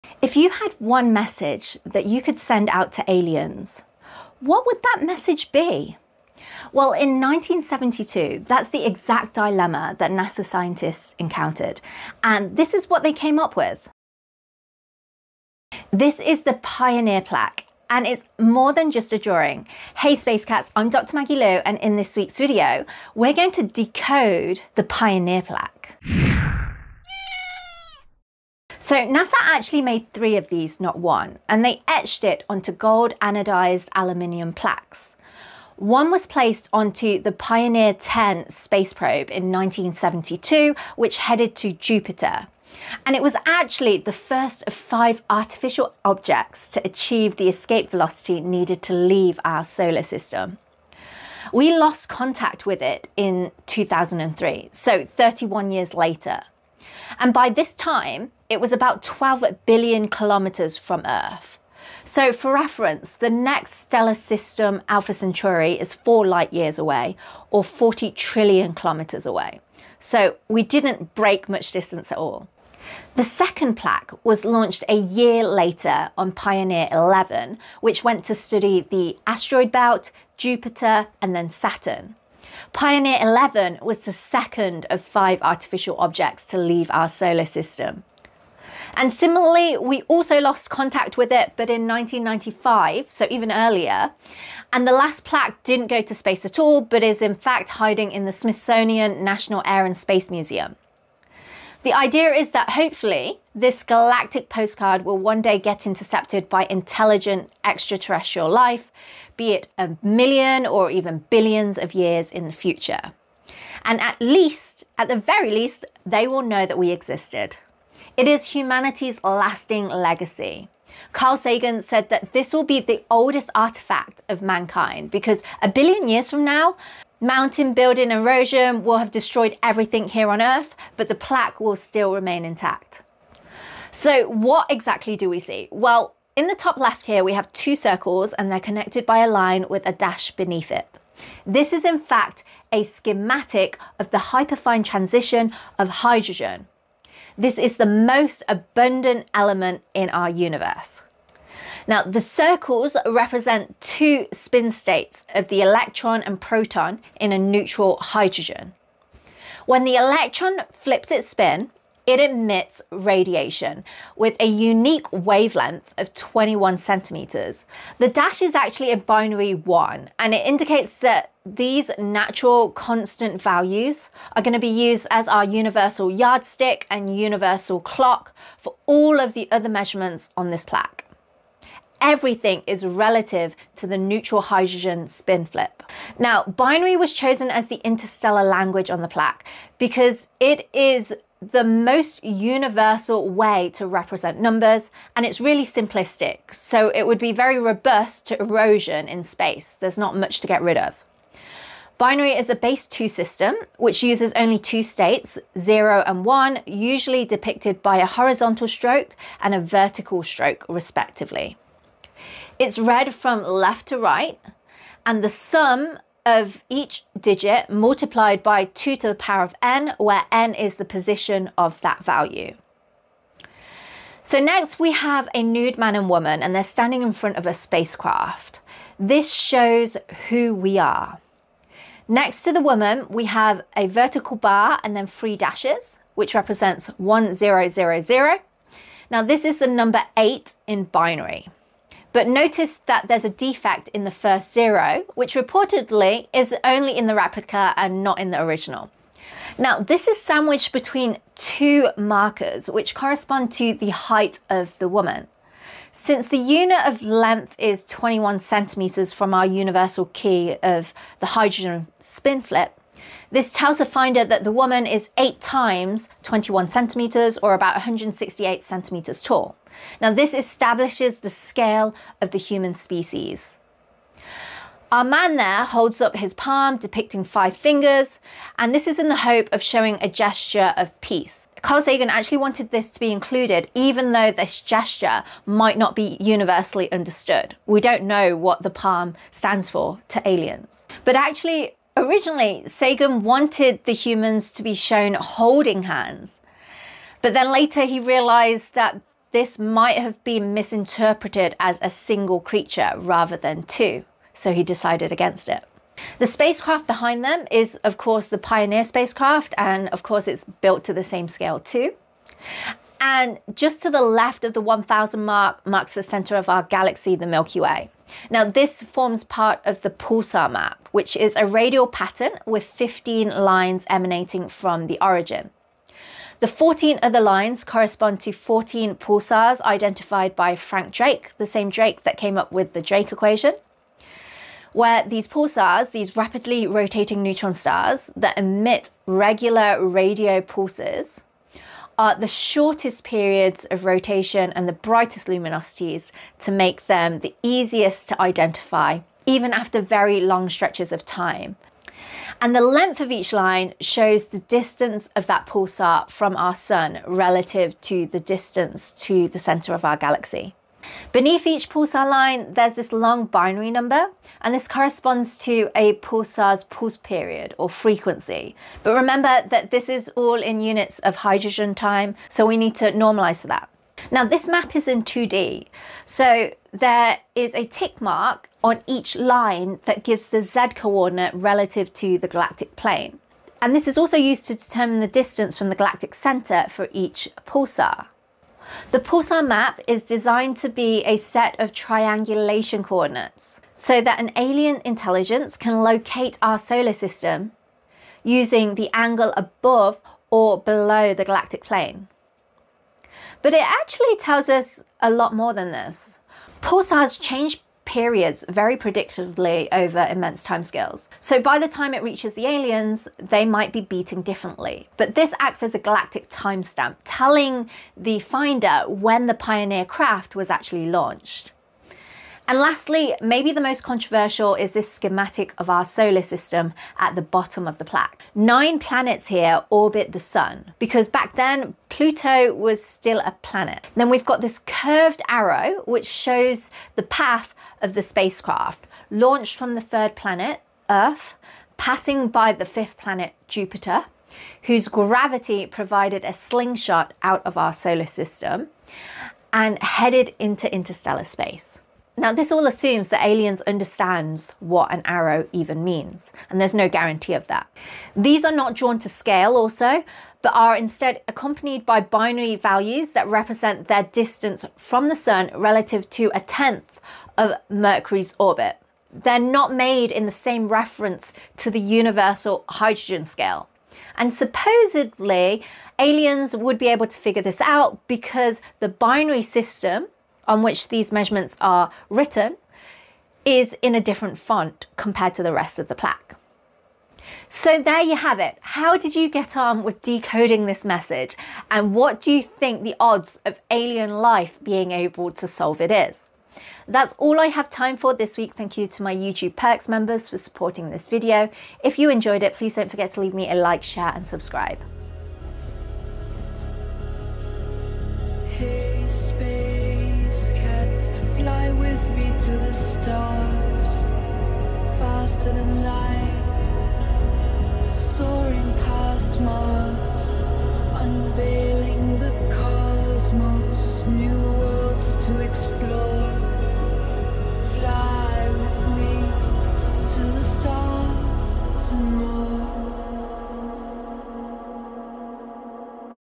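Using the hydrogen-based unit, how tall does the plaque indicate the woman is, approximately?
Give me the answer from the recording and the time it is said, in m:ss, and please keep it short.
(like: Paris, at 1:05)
168 centimetres, at 4:27.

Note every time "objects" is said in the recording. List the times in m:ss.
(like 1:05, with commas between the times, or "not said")
0:46, 1:25.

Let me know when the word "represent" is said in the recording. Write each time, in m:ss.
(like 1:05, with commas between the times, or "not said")
2:33, 3:13, 3:56, 7:43.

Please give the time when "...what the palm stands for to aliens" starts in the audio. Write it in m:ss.
4:48.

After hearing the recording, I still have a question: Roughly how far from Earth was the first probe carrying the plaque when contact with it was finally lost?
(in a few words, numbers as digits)
12 billion kilometers.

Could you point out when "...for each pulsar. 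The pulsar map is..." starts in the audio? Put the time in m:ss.
6:26.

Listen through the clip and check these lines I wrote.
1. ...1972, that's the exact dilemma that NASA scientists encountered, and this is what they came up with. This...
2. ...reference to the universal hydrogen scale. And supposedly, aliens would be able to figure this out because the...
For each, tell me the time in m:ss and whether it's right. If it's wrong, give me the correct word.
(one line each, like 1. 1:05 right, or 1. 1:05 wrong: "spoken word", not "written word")
1. 0:07 right
2. 7:50 right.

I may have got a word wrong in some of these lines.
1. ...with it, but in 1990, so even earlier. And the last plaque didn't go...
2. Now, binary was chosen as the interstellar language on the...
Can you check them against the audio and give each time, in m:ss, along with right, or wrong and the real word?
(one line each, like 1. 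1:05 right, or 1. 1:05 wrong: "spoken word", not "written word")
1. 1:31 wrong: "1995", not "1990"
2. 3:06 right.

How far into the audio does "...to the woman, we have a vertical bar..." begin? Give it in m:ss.
3:52.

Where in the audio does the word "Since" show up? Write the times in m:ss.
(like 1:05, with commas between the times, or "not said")
4:15.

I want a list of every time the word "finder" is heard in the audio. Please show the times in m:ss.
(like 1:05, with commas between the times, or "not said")
4:23, 6:58.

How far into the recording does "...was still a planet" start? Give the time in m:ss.
7:12.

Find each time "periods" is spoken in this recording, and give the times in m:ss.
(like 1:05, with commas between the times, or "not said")
5:43, 6:06, 6:47.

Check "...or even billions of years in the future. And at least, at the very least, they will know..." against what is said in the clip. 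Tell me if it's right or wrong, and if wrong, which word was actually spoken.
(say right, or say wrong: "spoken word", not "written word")
right.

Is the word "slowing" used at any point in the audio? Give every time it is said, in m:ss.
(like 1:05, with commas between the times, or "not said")
not said.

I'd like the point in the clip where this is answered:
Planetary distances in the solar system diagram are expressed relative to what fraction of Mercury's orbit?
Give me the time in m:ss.
7:46.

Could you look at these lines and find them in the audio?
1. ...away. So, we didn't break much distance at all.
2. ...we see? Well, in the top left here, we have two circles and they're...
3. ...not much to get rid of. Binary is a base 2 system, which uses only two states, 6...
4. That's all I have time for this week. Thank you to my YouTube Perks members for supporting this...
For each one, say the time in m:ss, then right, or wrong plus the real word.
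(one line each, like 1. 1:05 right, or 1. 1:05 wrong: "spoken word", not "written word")
1. 1:09 right
2. 2:15 right
3. 3:19 wrong: "0", not "6"
4. 8:16 right.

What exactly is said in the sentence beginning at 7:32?
Now, this all assumes that Aliens understands what an arrow even means, and there's no guarantee of that.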